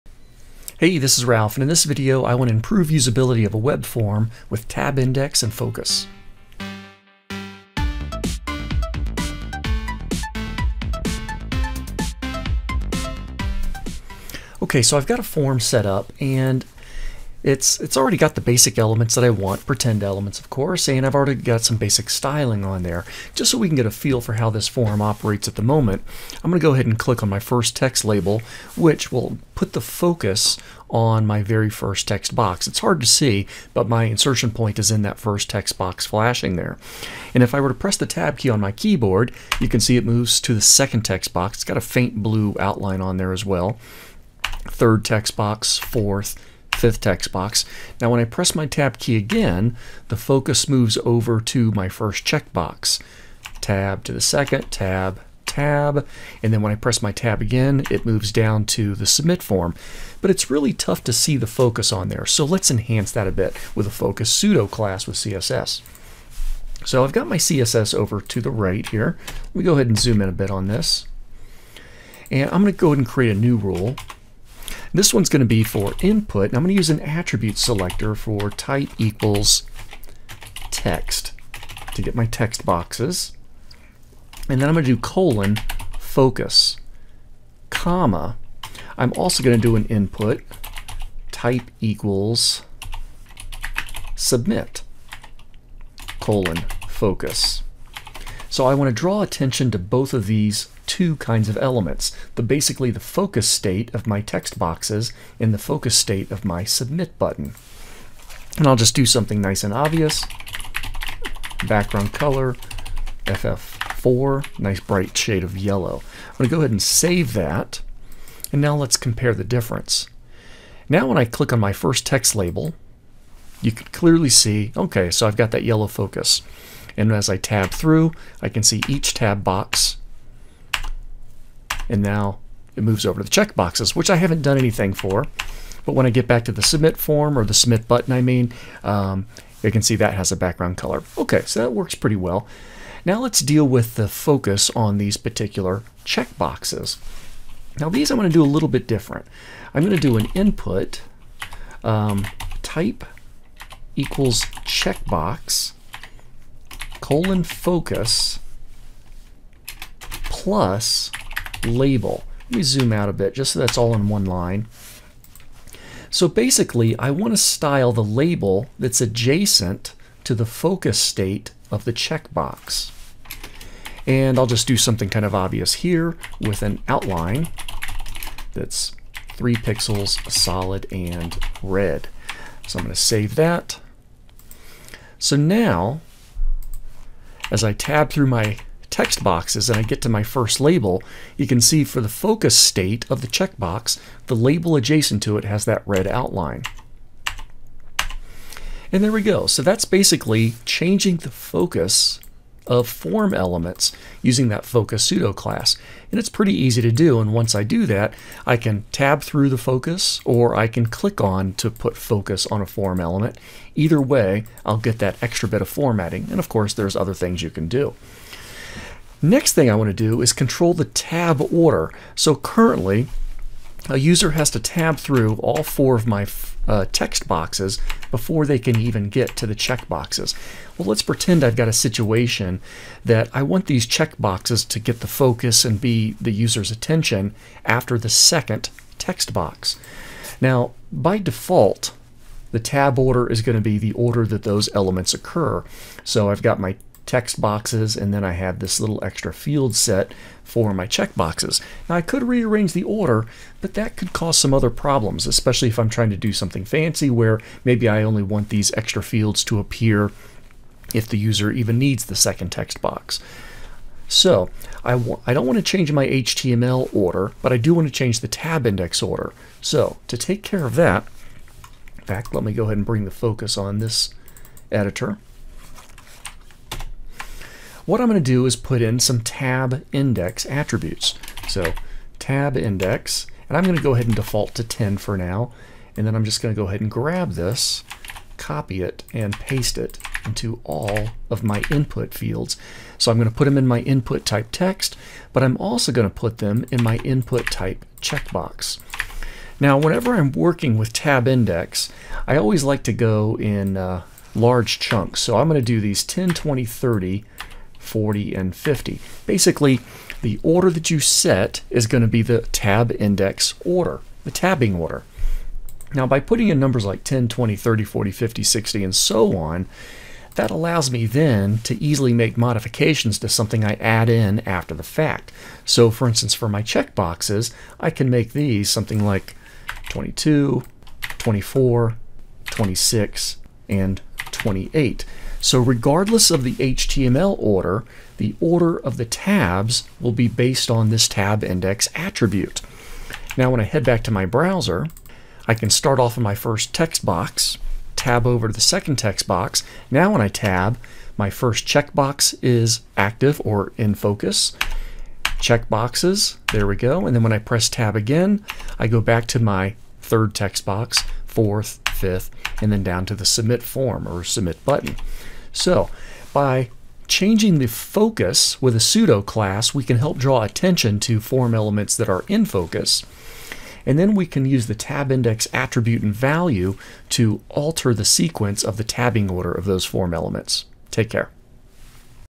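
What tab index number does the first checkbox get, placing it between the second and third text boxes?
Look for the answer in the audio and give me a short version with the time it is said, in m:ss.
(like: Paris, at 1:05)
22, at 5:29.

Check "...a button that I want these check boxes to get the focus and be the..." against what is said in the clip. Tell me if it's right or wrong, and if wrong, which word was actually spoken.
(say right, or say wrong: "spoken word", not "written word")
wrong: "situation", not "button".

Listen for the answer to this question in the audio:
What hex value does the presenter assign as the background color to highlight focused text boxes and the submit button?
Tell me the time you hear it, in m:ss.
1:53.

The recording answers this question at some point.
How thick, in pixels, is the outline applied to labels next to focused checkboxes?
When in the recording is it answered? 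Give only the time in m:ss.
2:59.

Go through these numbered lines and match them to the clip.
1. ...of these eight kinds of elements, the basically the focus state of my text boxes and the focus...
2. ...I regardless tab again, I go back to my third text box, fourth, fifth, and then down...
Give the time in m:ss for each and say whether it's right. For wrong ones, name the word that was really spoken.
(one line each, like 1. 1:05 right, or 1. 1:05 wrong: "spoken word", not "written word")
1. 1:40 wrong: "two", not "eight"
2. 5:57 wrong: "press", not "regardless".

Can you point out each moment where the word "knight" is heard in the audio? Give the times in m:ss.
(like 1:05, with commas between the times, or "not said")
not said.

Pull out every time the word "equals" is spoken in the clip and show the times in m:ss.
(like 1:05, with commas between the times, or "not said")
1:18, 1:31, 2:33.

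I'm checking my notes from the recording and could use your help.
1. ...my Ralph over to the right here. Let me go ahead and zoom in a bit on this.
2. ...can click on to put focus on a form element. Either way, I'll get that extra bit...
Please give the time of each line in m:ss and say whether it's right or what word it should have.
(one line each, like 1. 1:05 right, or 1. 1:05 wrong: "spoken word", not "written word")
1. 1:07 wrong: "CSS", not "Ralph"
2. 3:30 right.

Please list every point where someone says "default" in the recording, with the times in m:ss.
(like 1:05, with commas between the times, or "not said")
4:01, 4:44.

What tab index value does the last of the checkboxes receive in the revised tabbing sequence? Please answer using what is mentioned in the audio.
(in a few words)
28.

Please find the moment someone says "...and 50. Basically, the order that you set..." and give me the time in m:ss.
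5:08.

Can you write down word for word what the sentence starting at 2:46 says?
So basically, I want to style the label that's adjacent to the focus state of the checkbox.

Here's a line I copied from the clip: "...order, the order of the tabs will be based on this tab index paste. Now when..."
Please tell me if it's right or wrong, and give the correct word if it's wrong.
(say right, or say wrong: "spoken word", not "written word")
wrong: "attribute", not "paste".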